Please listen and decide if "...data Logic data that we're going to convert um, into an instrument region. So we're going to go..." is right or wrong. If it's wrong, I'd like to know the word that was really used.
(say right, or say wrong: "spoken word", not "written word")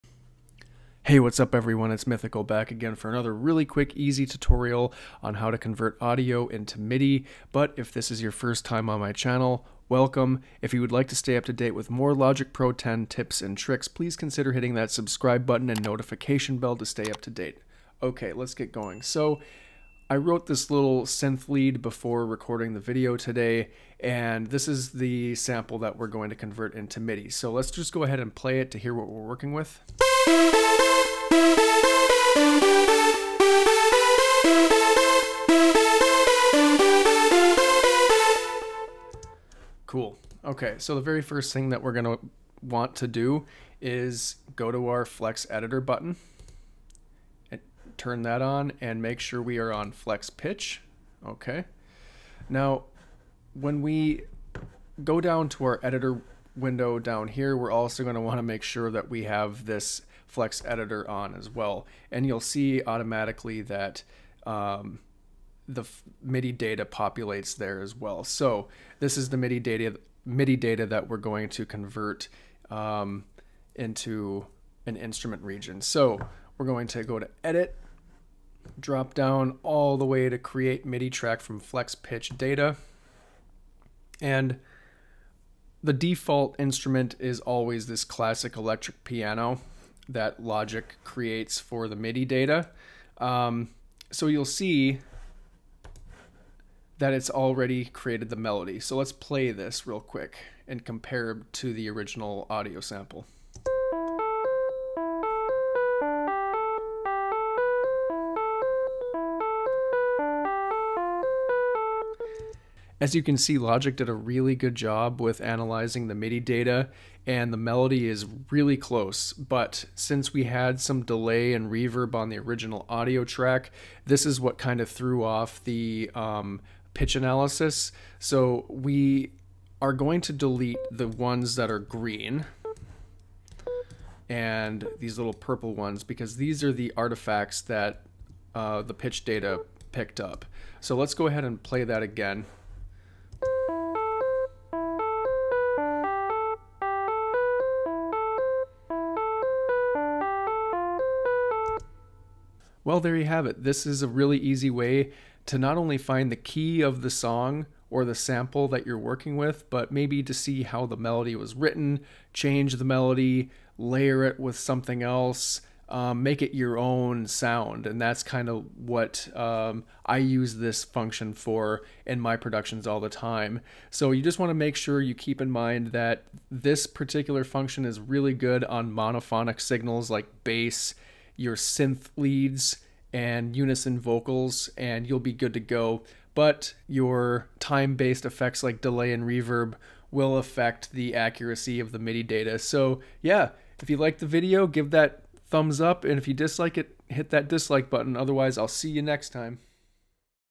wrong: "MIDI", not "Logic".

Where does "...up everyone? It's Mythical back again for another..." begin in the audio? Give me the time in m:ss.
0:01.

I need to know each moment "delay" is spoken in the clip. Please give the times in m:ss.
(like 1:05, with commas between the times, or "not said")
2:01, 3:08.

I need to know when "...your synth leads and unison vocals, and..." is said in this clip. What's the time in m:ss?
3:01.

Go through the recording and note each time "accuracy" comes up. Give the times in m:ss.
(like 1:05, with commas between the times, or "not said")
3:11.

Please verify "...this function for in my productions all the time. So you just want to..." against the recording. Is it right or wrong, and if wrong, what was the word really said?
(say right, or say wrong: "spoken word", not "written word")
right.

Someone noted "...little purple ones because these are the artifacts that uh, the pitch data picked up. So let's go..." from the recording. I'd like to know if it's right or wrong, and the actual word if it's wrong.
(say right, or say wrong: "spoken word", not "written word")
right.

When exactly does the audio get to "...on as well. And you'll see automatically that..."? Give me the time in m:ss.
1:01.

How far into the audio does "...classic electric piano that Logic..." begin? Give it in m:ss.
1:28.